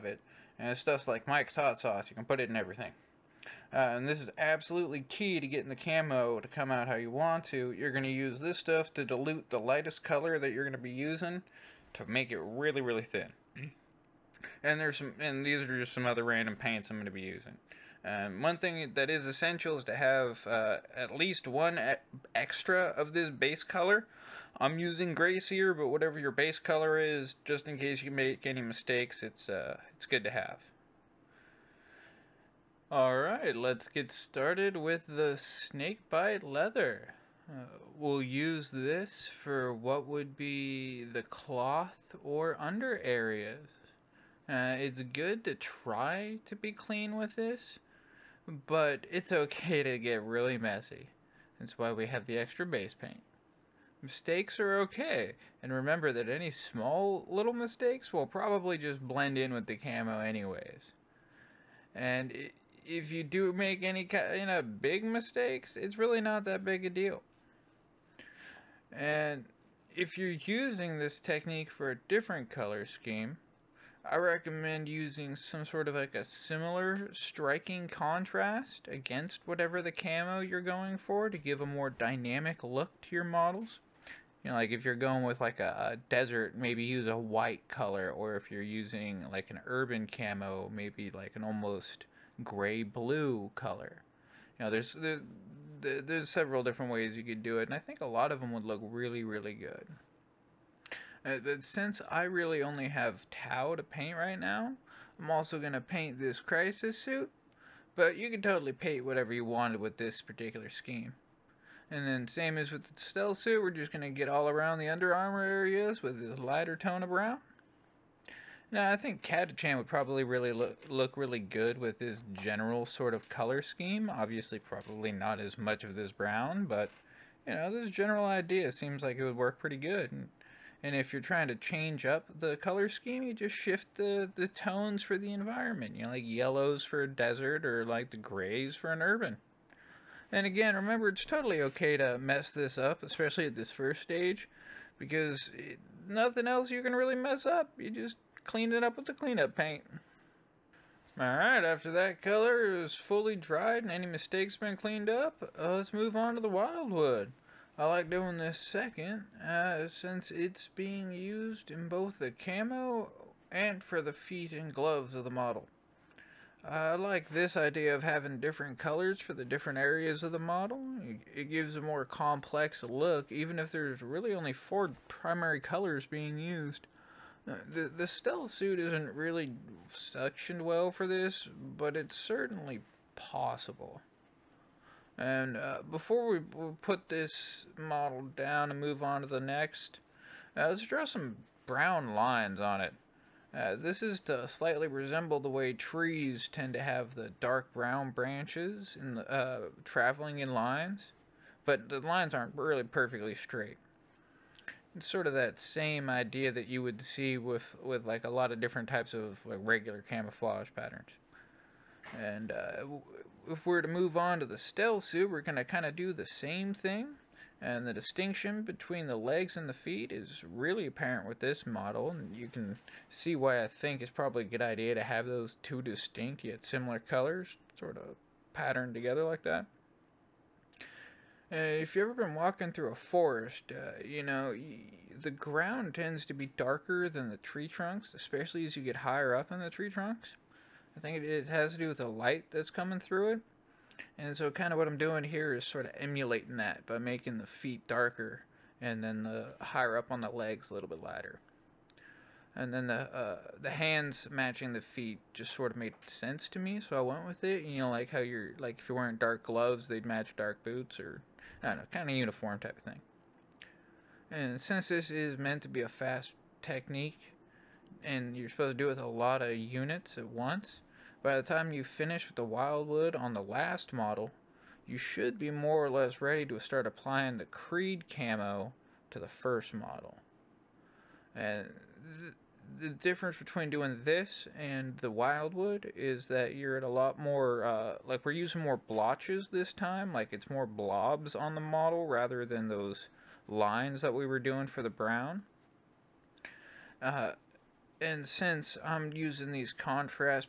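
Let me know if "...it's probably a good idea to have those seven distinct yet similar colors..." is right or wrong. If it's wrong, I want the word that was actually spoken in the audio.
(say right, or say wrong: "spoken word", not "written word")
wrong: "two", not "seven".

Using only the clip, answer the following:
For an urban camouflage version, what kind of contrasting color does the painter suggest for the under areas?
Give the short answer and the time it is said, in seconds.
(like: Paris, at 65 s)
gray blue, at 92 s.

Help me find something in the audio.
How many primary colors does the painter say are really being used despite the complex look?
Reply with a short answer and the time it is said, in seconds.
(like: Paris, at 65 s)
4, at 174 s.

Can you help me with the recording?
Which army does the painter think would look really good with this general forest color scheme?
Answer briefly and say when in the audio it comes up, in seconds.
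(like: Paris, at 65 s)
Catachan, at 119 s.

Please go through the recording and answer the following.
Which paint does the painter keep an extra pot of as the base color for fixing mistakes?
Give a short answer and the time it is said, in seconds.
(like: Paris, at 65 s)
Grey Seer, at 25 s.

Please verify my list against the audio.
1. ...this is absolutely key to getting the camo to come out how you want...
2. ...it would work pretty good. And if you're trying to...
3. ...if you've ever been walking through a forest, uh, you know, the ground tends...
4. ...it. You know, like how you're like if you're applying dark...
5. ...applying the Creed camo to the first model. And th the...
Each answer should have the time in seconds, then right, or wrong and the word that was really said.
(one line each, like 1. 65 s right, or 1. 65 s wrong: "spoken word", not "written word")
1. 4 s right
2. 129 s right
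3. 231 s right
4. 257 s wrong: "wearing", not "applying"
5. 276 s right.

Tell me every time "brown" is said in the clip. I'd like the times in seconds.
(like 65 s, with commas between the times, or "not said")
117 s, 126 s, 191 s, 197 s, 294 s.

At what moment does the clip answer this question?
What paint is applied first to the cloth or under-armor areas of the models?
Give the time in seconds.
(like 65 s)
35 s.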